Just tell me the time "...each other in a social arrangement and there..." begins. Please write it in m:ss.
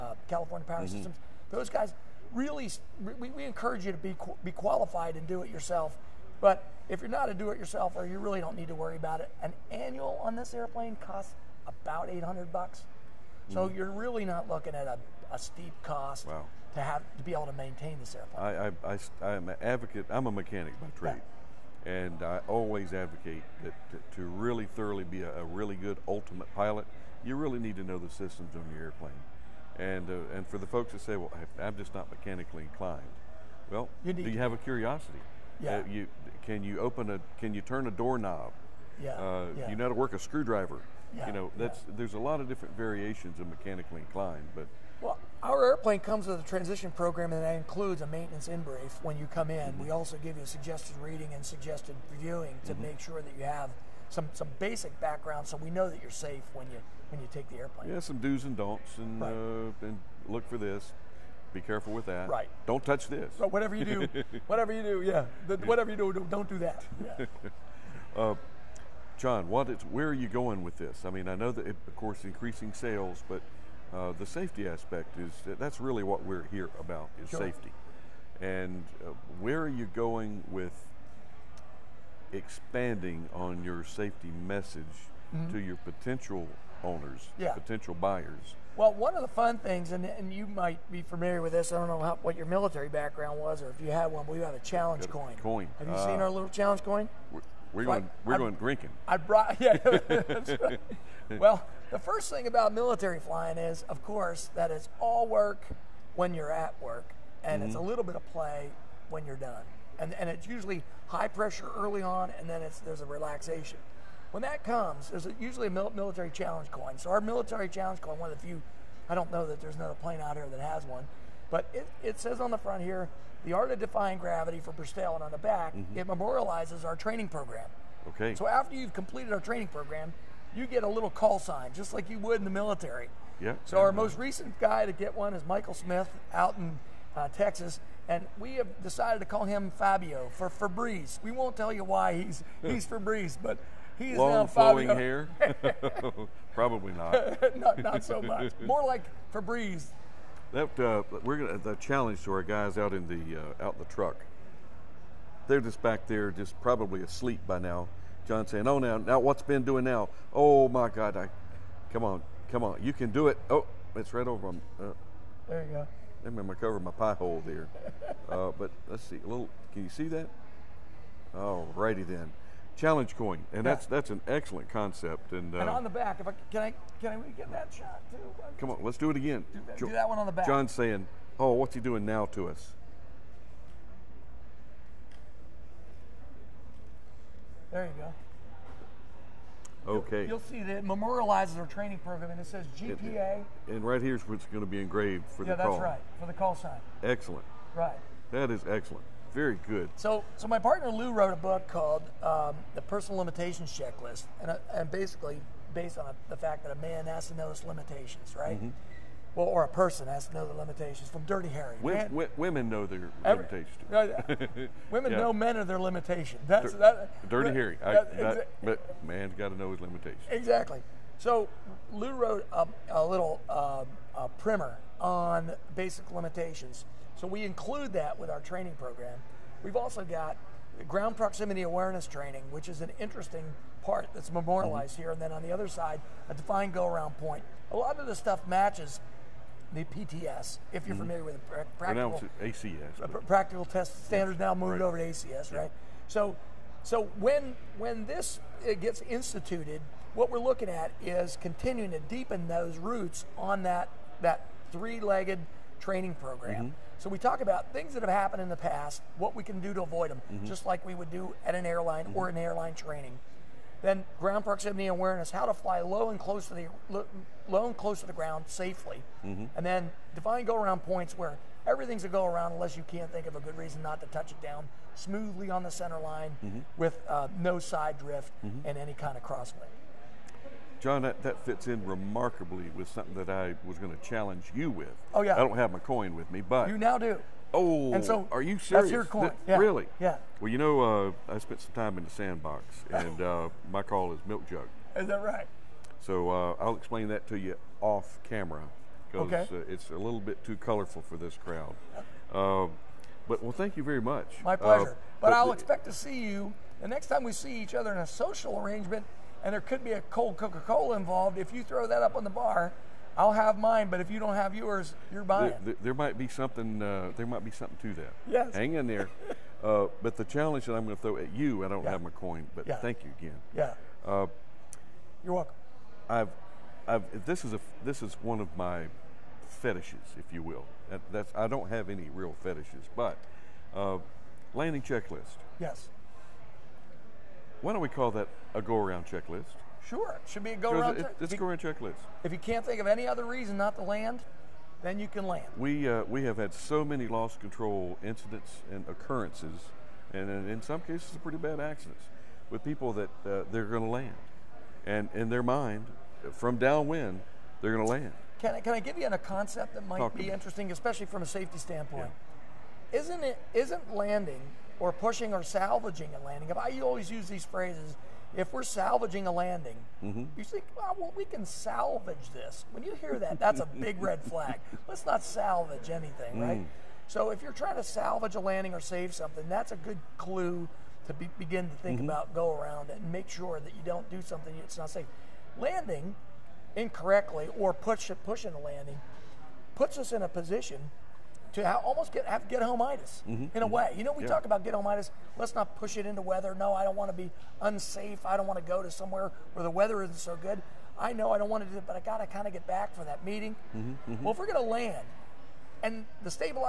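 5:07.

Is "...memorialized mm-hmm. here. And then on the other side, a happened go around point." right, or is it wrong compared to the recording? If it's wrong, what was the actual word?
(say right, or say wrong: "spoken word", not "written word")
wrong: "defined", not "happened".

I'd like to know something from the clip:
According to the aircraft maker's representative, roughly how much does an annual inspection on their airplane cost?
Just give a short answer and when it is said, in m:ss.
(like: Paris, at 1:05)
$800, at 0:12.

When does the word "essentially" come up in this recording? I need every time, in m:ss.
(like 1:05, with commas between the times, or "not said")
not said.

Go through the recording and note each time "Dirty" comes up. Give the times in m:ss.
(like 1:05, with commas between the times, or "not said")
3:31, 3:37.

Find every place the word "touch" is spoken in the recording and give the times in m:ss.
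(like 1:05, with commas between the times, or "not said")
1:02, 4:34.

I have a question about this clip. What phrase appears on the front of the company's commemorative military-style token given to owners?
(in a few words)
The Art of Defying Gravity.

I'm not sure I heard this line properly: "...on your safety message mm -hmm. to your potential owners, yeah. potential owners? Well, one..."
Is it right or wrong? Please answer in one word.
wrong.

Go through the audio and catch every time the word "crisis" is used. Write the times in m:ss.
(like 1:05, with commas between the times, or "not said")
not said.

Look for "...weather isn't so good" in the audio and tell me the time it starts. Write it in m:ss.
6:39.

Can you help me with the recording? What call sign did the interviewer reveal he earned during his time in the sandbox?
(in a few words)
Milk jug.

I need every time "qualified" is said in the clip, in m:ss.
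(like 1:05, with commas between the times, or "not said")
0:04.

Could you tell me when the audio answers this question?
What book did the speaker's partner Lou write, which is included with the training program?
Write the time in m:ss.
3:22.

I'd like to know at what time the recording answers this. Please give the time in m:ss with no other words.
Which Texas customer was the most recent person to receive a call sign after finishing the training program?
2:15.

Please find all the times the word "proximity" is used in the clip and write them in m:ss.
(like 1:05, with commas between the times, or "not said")
3:51, 4:24.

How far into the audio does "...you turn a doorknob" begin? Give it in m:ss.
0:37.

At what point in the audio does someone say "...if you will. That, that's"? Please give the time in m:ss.
5:30.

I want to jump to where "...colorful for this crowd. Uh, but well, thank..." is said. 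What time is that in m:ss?
5:00.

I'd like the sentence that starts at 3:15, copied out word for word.
Yeah, that's right for the call sign.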